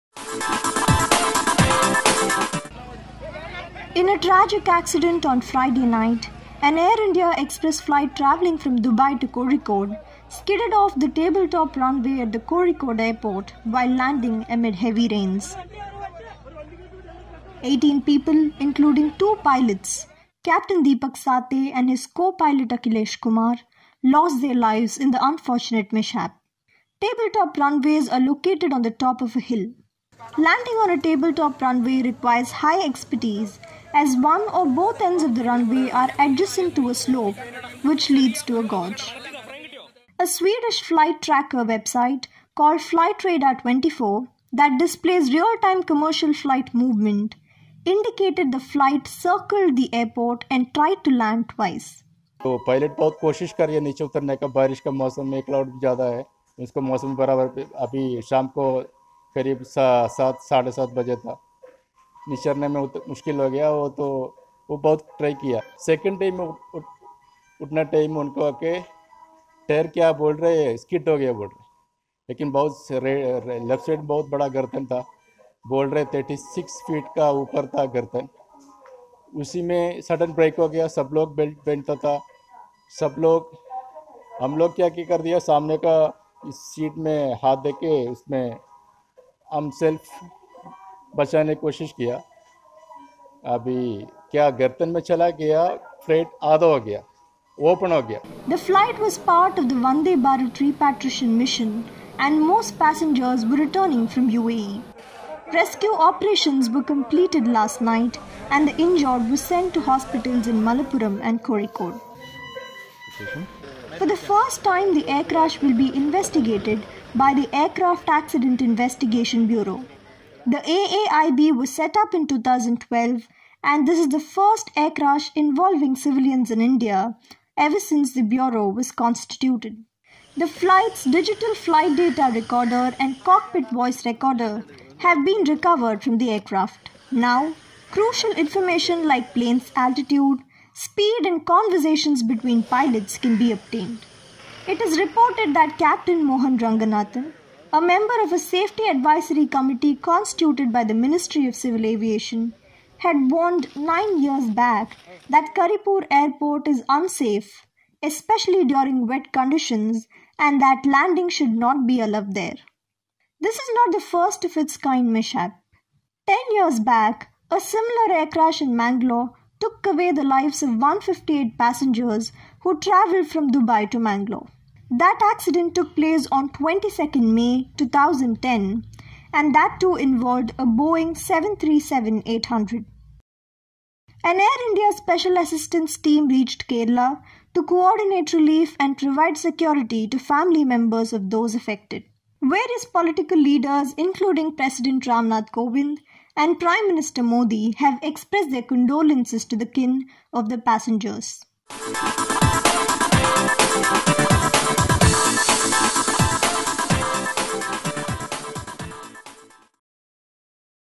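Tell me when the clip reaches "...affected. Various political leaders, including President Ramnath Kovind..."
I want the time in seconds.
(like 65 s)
191 s.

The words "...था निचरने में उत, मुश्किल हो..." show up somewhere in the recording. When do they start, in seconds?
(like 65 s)
61 s.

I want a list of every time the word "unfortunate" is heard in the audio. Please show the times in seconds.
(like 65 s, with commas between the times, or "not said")
25 s.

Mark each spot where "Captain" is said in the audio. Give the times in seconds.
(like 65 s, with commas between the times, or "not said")
20 s, 145 s.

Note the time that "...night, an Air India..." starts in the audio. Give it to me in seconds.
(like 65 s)
5 s.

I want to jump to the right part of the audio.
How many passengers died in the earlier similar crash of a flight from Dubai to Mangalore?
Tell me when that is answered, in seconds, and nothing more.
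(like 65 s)
170 s.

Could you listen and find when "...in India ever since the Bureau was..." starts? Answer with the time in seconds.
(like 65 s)
126 s.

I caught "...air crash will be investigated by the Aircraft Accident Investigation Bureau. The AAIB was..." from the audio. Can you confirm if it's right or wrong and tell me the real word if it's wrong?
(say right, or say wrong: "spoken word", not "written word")
right.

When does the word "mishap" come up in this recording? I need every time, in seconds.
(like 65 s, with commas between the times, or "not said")
25 s, 165 s.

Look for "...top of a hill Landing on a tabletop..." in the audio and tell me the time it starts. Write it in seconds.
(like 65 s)
28 s.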